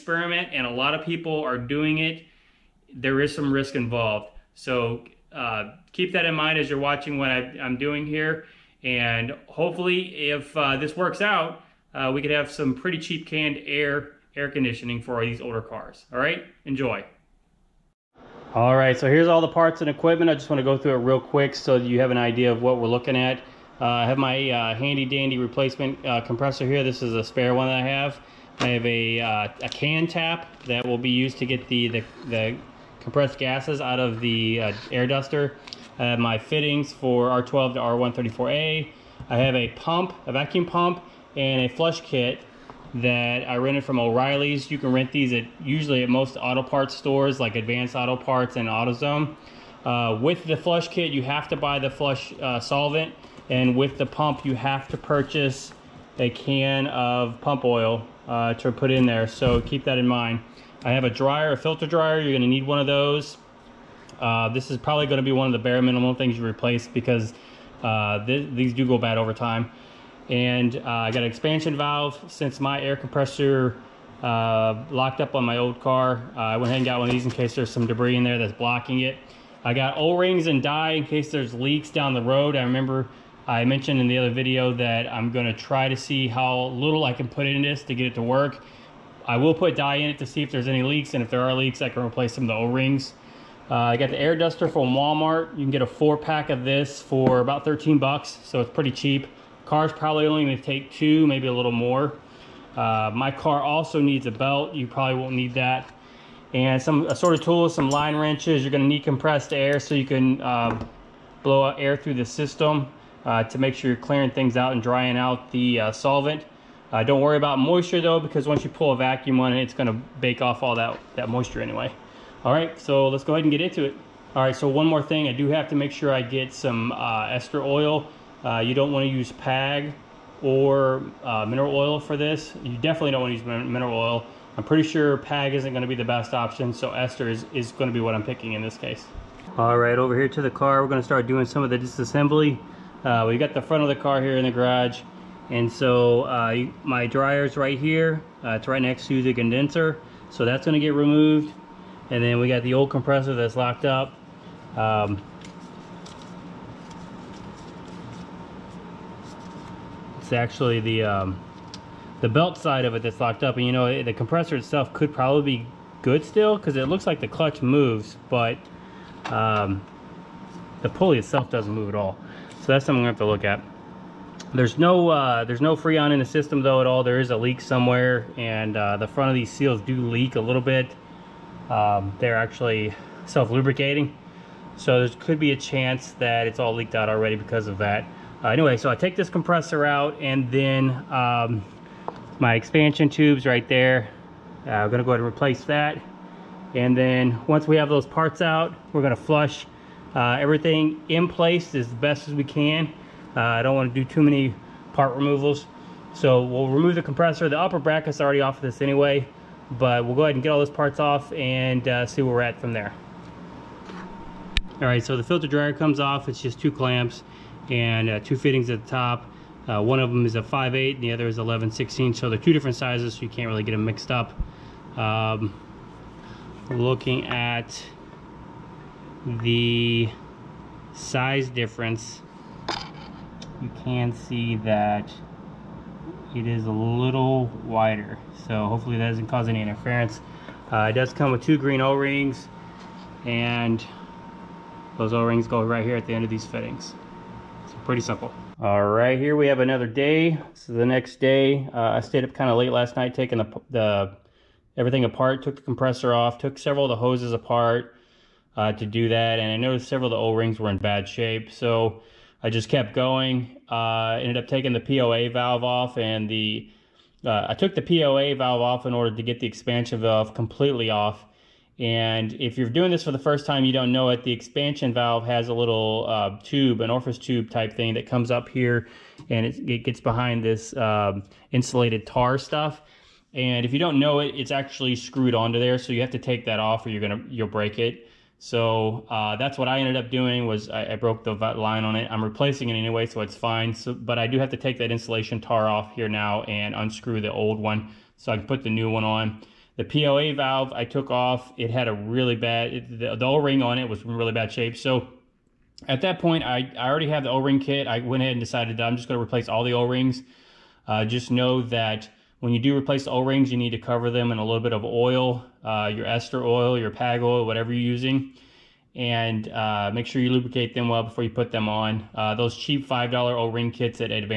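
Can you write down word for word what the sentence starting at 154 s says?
Um, it's actually the, um, the belt side of it that's locked up.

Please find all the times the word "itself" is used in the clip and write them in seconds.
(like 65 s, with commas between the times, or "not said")
164 s, 171 s.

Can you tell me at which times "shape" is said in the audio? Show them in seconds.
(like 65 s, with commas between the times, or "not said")
261 s, 304 s.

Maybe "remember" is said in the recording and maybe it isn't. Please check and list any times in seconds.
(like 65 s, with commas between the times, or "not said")
82 s.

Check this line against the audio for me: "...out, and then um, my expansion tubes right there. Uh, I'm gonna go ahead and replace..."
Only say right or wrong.
right.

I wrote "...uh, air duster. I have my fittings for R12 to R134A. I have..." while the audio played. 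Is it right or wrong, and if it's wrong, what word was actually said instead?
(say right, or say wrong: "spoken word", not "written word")
right.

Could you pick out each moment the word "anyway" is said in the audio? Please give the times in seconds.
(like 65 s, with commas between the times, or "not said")
121 s, 188 s, 208 s, 292 s.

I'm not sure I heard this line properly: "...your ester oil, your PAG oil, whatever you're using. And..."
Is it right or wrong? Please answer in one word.
right.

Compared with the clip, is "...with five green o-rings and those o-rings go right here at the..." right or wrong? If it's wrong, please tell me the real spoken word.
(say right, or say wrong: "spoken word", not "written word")
wrong: "two", not "five".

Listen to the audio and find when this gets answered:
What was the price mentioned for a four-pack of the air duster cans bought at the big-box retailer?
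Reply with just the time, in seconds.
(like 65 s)
97 s.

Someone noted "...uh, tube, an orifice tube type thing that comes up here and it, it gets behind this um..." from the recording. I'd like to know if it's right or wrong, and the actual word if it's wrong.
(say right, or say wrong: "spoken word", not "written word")
right.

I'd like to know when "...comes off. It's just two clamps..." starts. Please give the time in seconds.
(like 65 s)
215 s.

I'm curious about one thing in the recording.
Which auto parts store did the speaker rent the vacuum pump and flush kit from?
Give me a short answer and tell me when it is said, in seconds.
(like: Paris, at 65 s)
O'Reilly's, at 44 s.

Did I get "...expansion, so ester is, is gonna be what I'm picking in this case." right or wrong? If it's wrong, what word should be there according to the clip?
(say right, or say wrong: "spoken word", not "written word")
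wrong: "option", not "expansion".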